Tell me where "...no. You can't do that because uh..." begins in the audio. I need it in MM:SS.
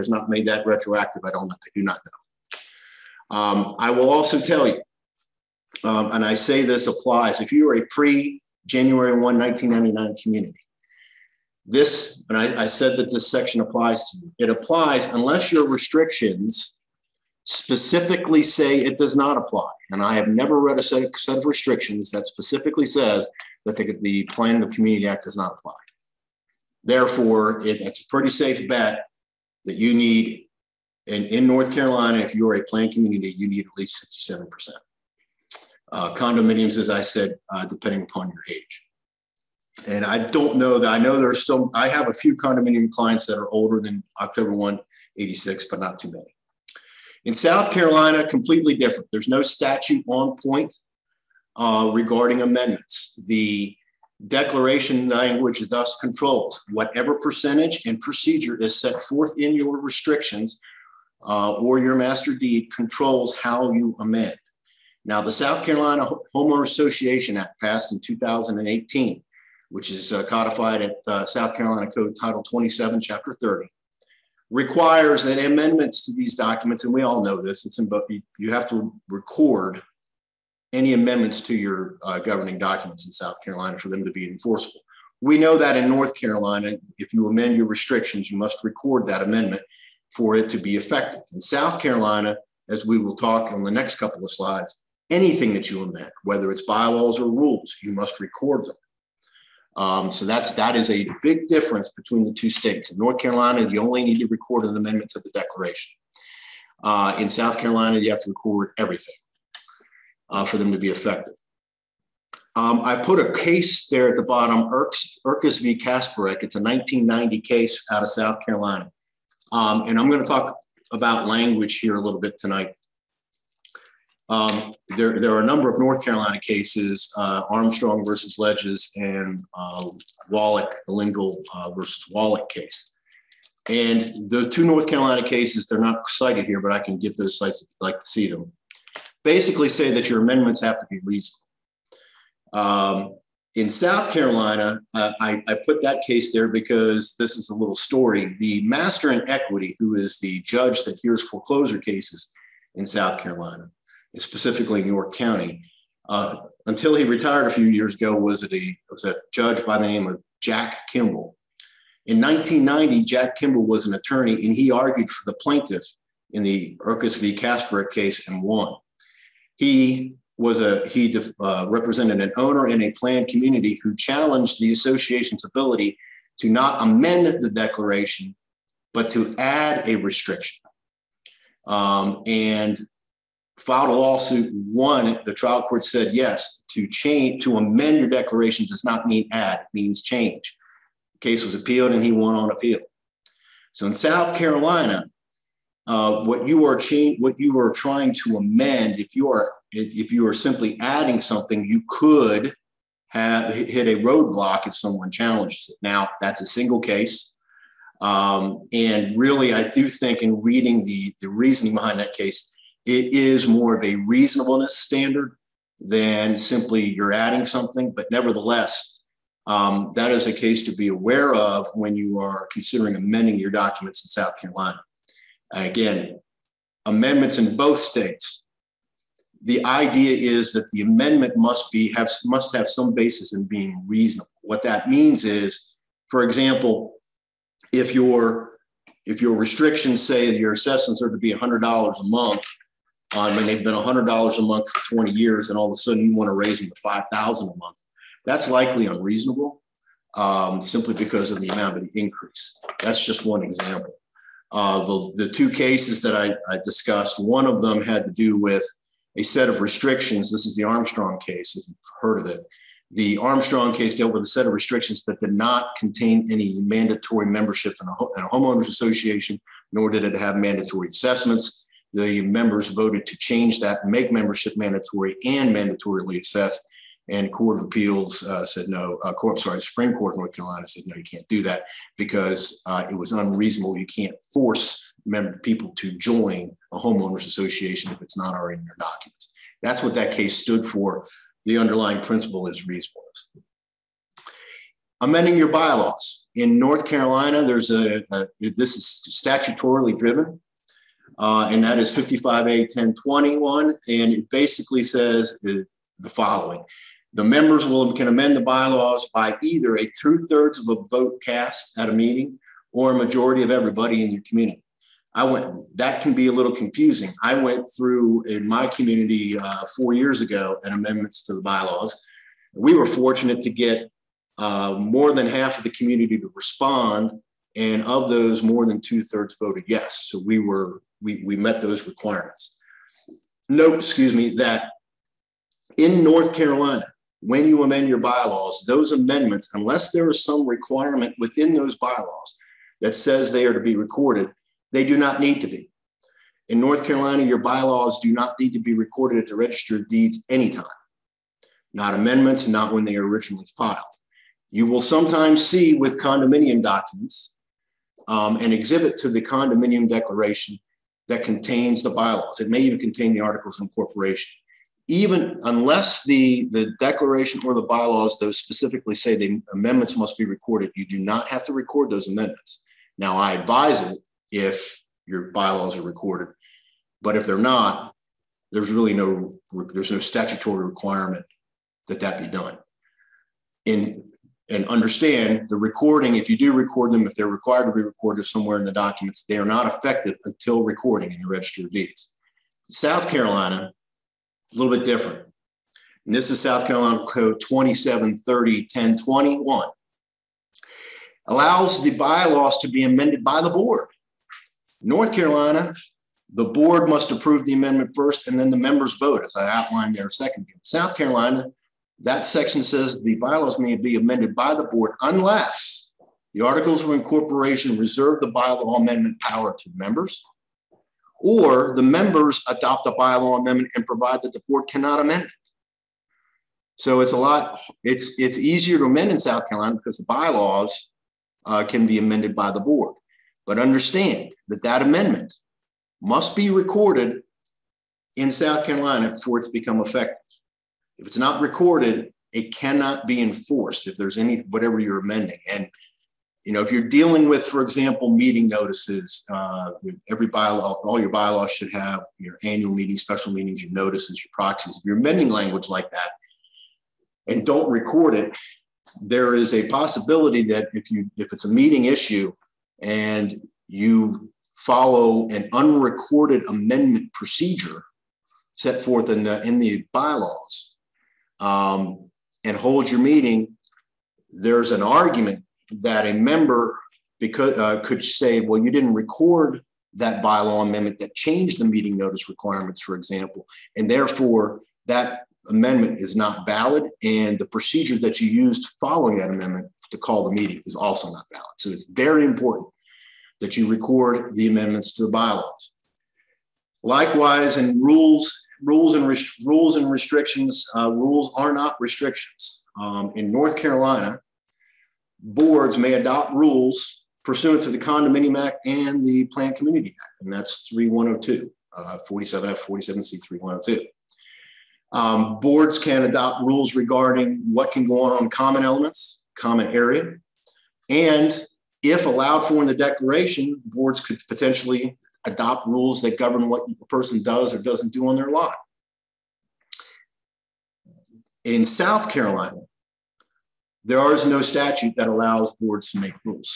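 04:40.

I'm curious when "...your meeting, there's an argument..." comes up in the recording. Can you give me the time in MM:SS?
07:52.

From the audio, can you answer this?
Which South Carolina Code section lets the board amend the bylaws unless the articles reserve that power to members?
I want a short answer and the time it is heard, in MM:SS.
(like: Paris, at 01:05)
27-30-1021, at 06:37.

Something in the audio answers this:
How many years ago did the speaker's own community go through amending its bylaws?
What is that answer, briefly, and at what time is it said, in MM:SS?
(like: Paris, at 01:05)
4, at 05:19.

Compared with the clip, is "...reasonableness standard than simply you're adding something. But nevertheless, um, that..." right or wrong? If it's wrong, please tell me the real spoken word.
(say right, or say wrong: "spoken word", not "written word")
right.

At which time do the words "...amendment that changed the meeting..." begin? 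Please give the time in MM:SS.
08:00.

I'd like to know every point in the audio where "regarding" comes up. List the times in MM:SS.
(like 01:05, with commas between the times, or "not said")
00:51, 08:36.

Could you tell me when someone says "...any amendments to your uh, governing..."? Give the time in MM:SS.
01:20.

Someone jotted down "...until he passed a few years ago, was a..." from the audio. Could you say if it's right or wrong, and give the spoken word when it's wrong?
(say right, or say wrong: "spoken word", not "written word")
wrong: "retired", not "passed".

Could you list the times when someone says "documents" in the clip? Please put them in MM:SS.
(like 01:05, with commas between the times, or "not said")
01:16, 01:22, 03:43, 04:48, 05:56, 06:28.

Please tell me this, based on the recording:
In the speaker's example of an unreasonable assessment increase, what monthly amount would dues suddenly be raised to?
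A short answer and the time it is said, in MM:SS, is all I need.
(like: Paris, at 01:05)
$5,000, at 04:06.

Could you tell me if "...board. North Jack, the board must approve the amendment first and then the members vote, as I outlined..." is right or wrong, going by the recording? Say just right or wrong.
wrong.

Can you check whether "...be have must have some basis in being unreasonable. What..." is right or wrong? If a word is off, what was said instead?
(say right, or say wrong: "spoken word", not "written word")
wrong: "reasonable", not "unreasonable".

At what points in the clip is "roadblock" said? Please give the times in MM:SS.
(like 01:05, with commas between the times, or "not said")
03:24.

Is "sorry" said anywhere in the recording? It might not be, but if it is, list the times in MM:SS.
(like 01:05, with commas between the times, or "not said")
04:39.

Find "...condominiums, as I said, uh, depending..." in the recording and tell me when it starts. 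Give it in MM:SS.
00:36.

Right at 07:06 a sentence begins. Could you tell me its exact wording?
So it's a lot, it's, it's easier to amend in South Carolina because the bylaws uh, can be amended by the board.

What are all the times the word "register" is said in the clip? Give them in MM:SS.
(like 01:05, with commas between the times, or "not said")
05:49, 06:31.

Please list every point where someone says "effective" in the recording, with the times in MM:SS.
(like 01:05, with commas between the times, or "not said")
01:30, 01:50, 06:29, 07:19.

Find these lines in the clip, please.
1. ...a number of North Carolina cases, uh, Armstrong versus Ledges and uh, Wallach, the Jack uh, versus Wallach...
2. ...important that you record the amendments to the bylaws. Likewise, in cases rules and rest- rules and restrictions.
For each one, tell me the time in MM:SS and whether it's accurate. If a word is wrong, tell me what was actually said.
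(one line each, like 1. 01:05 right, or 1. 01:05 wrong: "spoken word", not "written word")
1. 02:05 wrong: "Lingle", not "Jack"
2. 08:12 wrong: "rules", not "cases".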